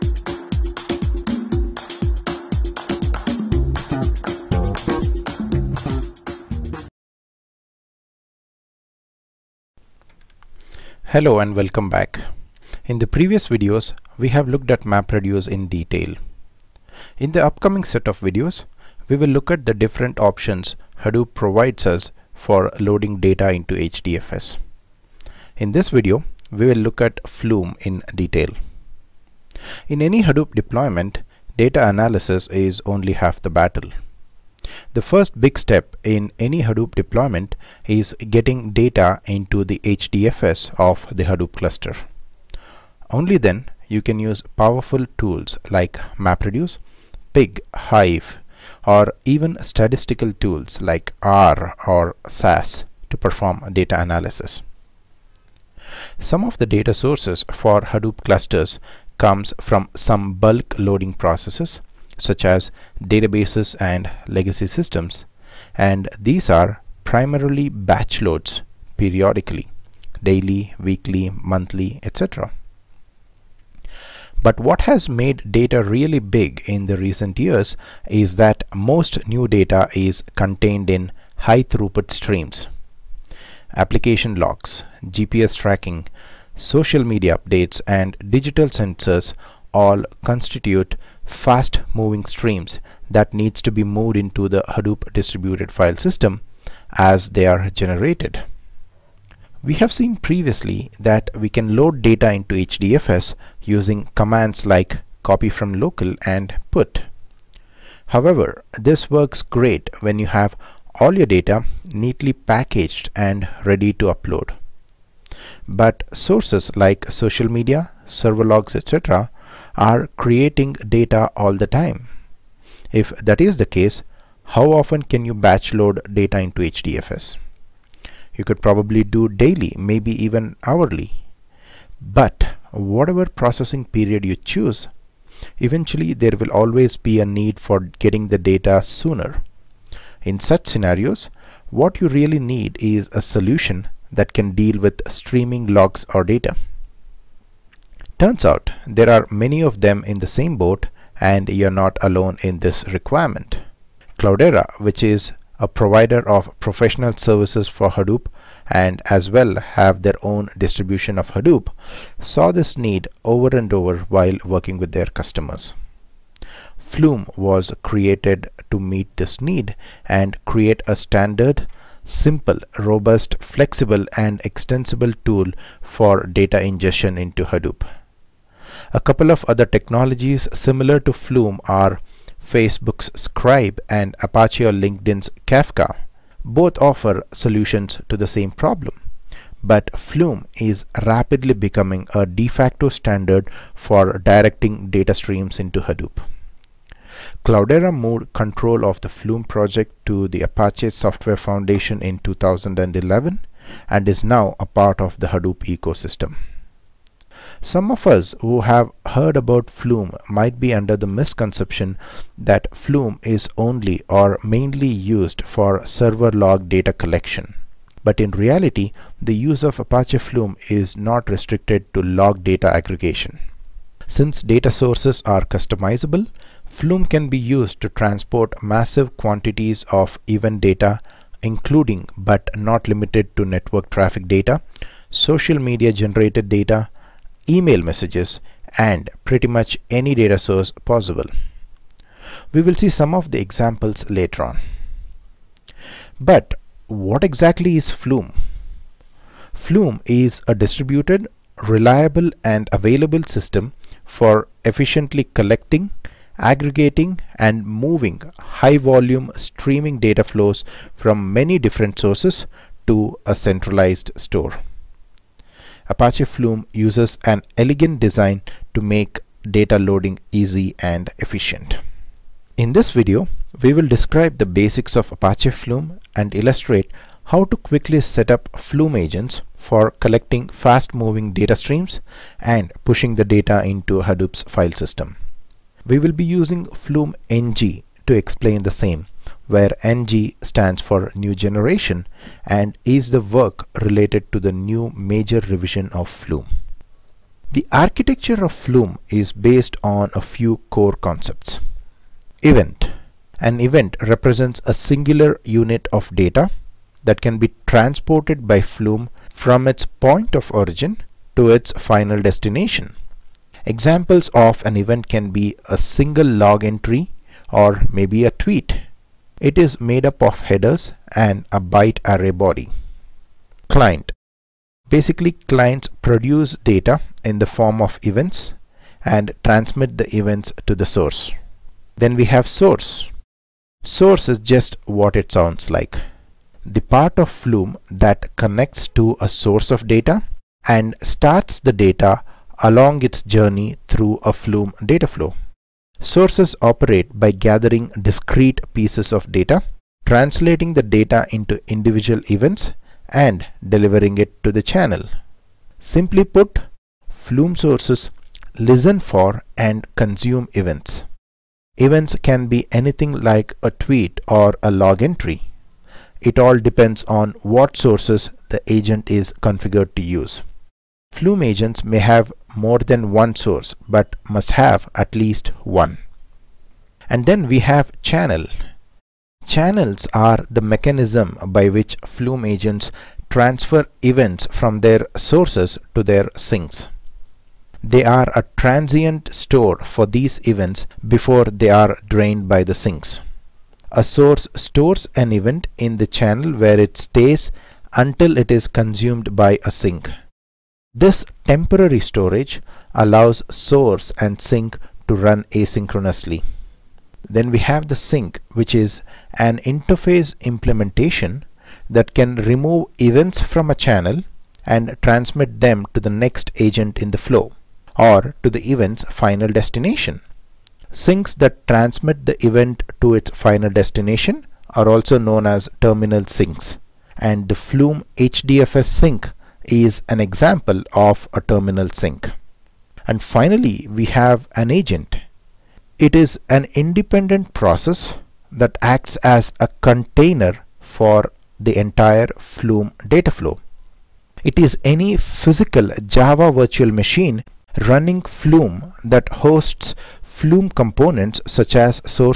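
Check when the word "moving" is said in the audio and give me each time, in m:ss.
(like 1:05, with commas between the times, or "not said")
1:31, 4:17, 4:40.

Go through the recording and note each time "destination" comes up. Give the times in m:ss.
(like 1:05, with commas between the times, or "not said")
5:12, 6:59, 7:03.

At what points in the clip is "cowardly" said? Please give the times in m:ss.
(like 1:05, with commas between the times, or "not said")
not said.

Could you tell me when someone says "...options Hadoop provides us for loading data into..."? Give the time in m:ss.
0:20.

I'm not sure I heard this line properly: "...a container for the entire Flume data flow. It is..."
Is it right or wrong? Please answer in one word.
right.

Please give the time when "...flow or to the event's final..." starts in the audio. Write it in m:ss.
6:57.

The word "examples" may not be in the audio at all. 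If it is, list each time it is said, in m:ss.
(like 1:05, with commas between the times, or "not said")
4:03, 5:13, 7:10.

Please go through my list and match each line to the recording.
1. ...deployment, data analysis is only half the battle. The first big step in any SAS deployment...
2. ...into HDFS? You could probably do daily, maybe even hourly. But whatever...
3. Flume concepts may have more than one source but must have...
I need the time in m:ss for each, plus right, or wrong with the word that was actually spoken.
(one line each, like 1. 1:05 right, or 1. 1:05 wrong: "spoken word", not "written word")
1. 0:30 wrong: "Hadoop", not "SAS"
2. 2:06 right
3. 6:11 wrong: "agents", not "concepts".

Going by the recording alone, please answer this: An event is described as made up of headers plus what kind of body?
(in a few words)
byte array body.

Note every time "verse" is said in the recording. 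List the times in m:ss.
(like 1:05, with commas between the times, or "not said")
not said.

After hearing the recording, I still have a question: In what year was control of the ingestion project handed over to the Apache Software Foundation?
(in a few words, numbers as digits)
2011.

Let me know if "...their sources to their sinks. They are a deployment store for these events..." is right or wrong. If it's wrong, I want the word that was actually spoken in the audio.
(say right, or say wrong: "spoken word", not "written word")
wrong: "transient", not "deployment".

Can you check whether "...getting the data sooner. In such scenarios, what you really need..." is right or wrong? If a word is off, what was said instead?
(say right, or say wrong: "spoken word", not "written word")
right.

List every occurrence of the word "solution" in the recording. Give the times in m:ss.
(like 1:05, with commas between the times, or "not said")
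2:23, 3:07.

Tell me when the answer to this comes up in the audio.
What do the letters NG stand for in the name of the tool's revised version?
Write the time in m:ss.
4:51.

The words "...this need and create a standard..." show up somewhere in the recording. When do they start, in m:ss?
2:49.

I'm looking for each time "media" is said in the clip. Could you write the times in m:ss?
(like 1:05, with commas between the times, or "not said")
1:27, 1:57, 3:55.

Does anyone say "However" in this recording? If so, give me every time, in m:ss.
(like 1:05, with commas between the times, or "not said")
1:48.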